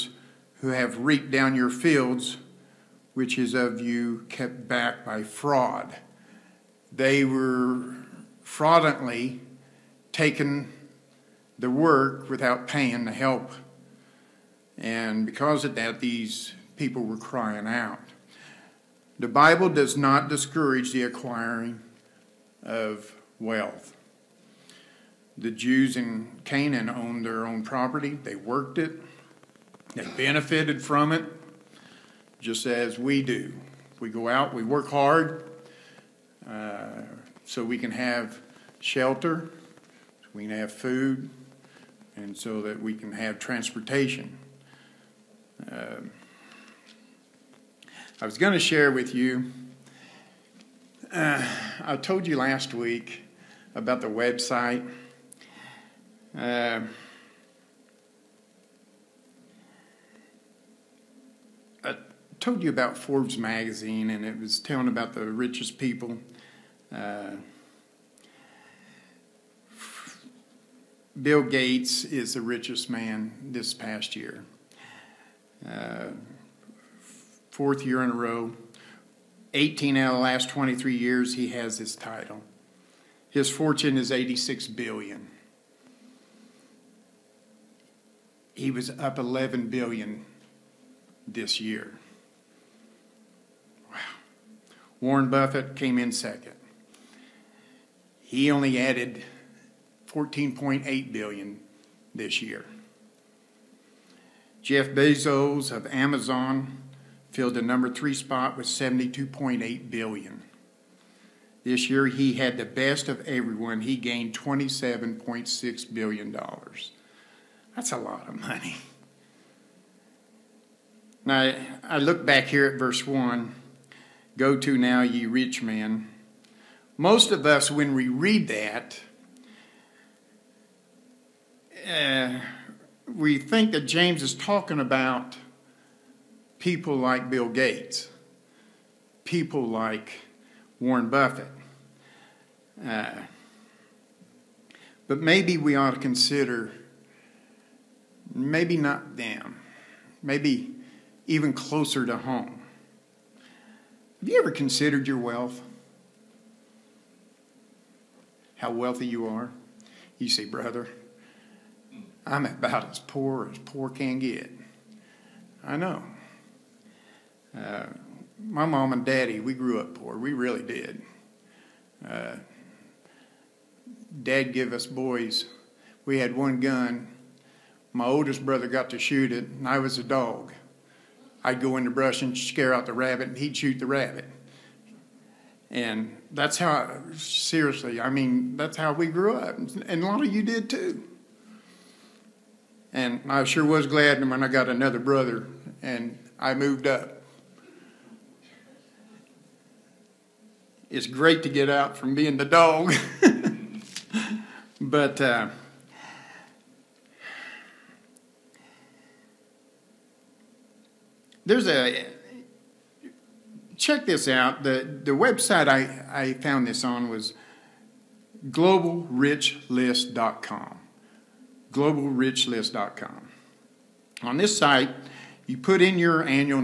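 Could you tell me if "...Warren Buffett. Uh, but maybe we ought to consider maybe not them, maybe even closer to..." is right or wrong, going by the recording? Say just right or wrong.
right.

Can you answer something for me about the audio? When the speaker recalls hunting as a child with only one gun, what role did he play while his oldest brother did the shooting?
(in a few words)
the dog.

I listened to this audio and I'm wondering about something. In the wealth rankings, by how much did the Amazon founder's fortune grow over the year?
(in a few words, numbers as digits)
27.6 billion dollars.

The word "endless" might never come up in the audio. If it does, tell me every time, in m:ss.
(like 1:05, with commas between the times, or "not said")
not said.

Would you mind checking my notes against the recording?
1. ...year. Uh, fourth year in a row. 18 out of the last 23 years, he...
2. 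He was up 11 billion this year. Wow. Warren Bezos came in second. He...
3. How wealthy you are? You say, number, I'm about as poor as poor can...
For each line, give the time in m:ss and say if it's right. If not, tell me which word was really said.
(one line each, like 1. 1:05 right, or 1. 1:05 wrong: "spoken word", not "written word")
1. 1:14 right
2. 1:28 wrong: "Buffett", not "Bezos"
3. 2:38 wrong: "brother", not "number".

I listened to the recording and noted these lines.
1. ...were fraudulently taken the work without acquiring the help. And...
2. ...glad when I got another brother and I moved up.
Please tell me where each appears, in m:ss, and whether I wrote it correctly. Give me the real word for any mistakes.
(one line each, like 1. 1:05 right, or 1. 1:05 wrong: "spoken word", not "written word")
1. 0:07 wrong: "paying", not "acquiring"
2. 3:13 right.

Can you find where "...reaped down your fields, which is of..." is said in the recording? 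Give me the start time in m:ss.
0:00.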